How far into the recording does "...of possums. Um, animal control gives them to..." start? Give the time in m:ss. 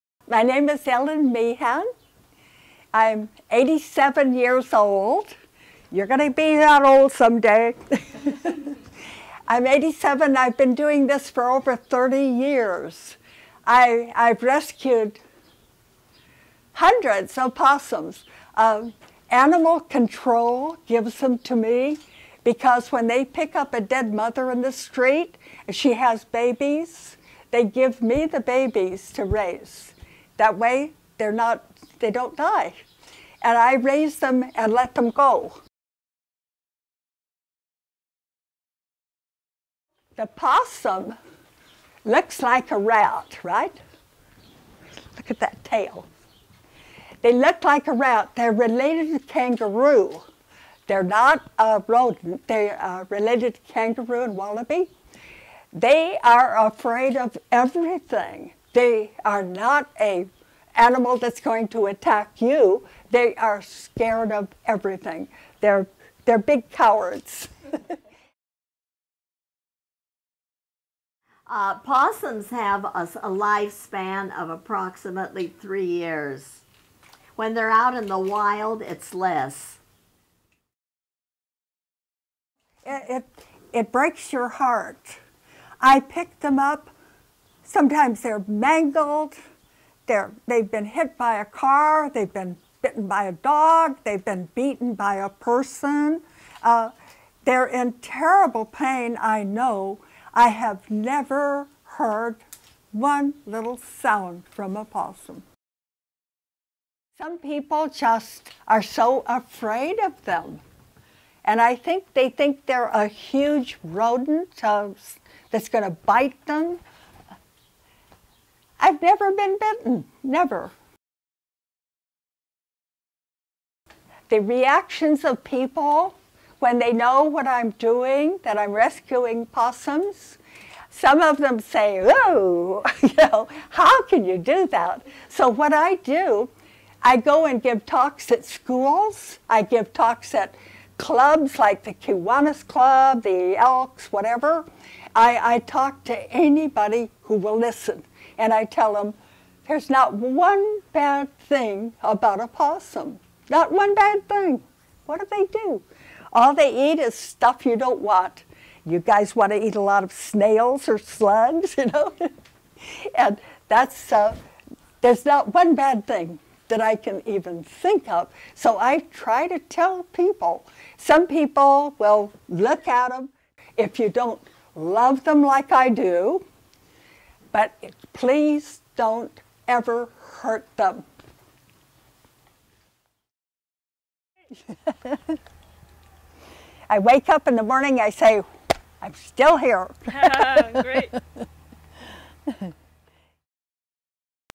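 0:17.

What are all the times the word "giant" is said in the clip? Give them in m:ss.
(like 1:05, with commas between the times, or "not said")
not said.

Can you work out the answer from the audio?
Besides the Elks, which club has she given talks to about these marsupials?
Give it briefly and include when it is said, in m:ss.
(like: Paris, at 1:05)
Kiwanis Club, at 2:21.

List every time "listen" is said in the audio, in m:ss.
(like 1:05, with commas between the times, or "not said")
2:27.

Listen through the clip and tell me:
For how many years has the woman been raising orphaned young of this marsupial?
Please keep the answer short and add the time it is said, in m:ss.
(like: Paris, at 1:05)
over 30 years, at 0:11.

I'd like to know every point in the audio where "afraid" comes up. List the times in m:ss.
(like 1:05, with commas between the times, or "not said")
0:56, 1:49.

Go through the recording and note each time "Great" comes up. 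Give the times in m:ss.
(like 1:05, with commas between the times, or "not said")
3:10.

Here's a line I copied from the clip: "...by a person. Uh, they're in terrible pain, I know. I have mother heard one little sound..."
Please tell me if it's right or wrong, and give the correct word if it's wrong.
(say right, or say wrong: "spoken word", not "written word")
wrong: "never", not "mother".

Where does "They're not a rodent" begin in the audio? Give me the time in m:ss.
0:50.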